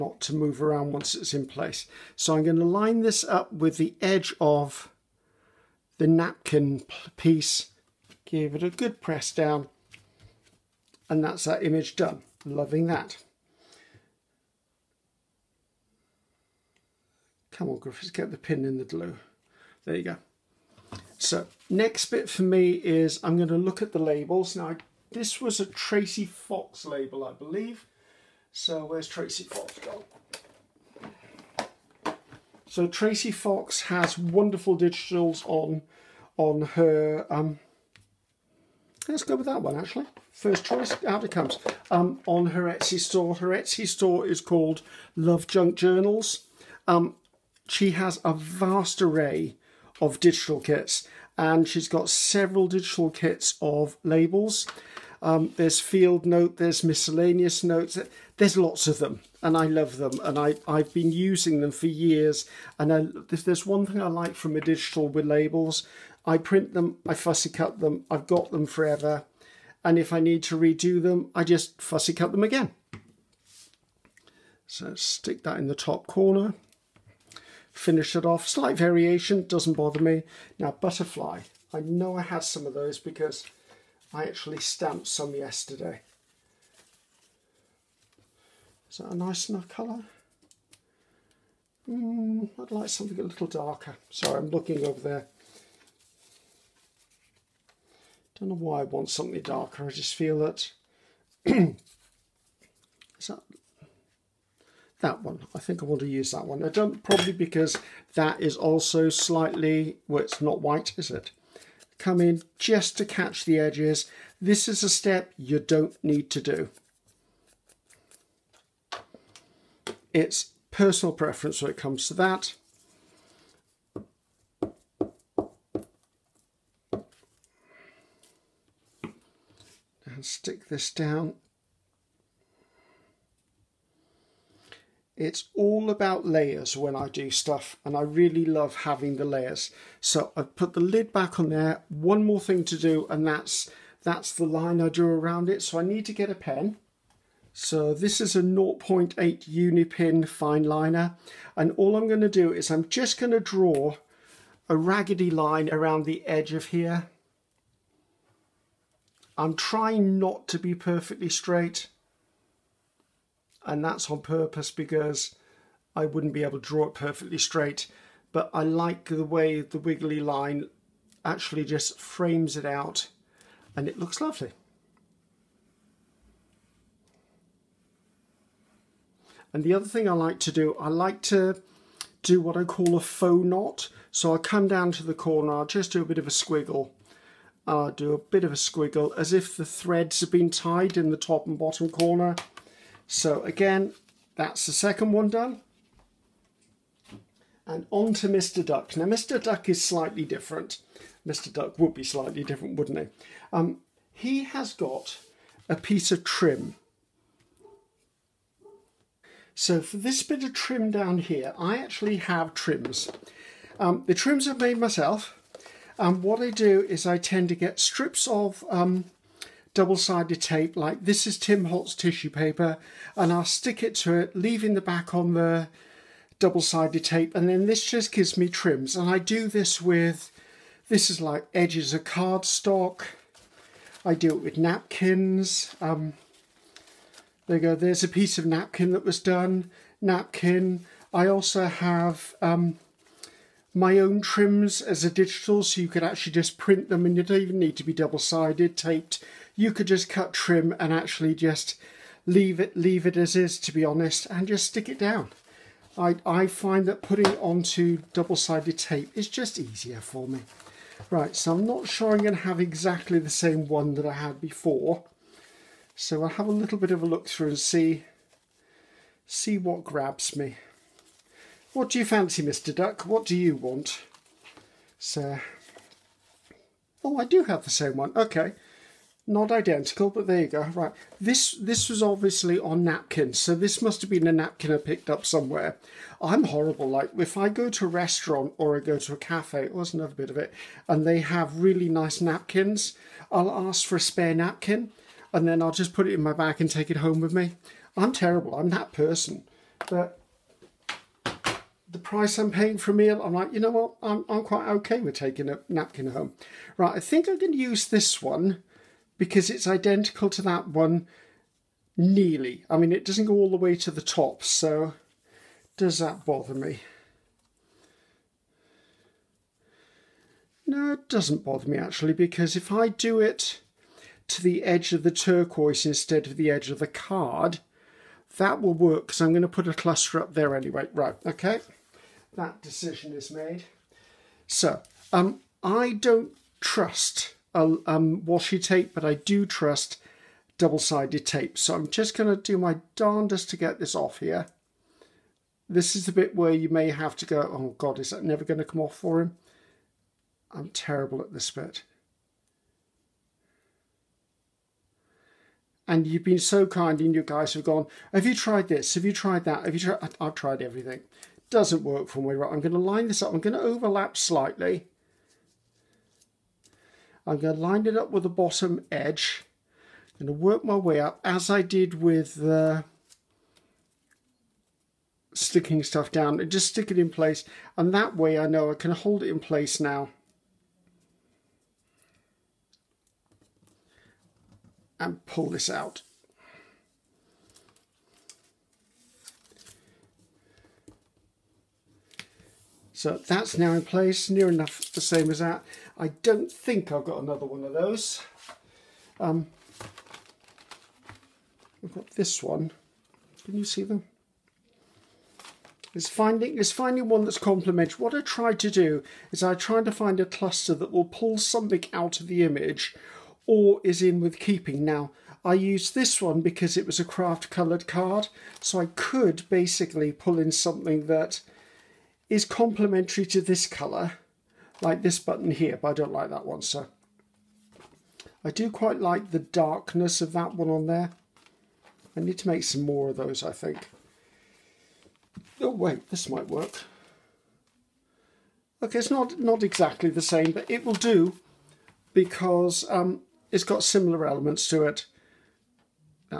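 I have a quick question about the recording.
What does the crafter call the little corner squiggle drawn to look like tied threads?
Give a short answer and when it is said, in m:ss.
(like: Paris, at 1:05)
faux knot, at 3:02.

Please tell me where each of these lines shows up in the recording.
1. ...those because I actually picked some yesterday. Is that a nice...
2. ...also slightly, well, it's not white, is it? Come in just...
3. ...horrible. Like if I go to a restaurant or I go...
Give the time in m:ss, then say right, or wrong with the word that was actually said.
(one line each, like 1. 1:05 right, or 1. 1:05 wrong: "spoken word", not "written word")
1. 1:22 wrong: "stamped", not "picked"
2. 1:48 right
3. 4:46 right.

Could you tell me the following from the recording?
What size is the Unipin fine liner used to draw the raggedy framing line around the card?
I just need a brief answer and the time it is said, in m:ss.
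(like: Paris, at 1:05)
0.8, at 2:28.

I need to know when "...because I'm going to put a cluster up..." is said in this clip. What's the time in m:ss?
5:29.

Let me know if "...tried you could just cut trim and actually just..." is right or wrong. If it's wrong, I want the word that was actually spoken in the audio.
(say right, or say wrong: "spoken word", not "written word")
wrong: "taped", not "tried".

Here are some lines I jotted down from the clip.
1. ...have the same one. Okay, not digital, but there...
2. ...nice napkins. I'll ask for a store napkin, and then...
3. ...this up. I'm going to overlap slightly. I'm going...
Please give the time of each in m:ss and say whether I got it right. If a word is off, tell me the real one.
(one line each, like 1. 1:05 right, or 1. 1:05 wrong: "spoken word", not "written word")
1. 4:37 wrong: "identical", not "digital"
2. 4:51 wrong: "spare", not "store"
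3. 6:03 right.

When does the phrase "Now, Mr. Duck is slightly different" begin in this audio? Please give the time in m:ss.
3:18.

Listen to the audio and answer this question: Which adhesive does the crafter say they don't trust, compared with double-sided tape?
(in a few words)
washi tape.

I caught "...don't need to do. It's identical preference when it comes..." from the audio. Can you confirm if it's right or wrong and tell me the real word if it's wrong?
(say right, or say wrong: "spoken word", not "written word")
wrong: "personal", not "identical".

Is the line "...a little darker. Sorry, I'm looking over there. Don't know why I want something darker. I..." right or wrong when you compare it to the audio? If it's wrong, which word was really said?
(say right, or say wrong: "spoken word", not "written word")
right.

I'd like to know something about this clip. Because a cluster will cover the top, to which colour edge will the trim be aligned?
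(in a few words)
turquoise.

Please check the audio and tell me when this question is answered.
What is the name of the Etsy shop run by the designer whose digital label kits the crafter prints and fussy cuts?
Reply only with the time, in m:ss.
0:45.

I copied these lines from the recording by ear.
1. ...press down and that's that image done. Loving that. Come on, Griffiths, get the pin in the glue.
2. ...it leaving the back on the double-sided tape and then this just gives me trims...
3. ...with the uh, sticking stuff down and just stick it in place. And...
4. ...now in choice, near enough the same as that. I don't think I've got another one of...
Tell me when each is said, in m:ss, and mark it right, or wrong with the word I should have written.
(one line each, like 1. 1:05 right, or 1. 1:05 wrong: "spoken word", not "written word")
1. 0:09 right
2. 3:44 right
3. 6:12 right
4. 6:33 wrong: "place", not "choice".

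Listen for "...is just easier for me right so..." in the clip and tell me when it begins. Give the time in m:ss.
4:19.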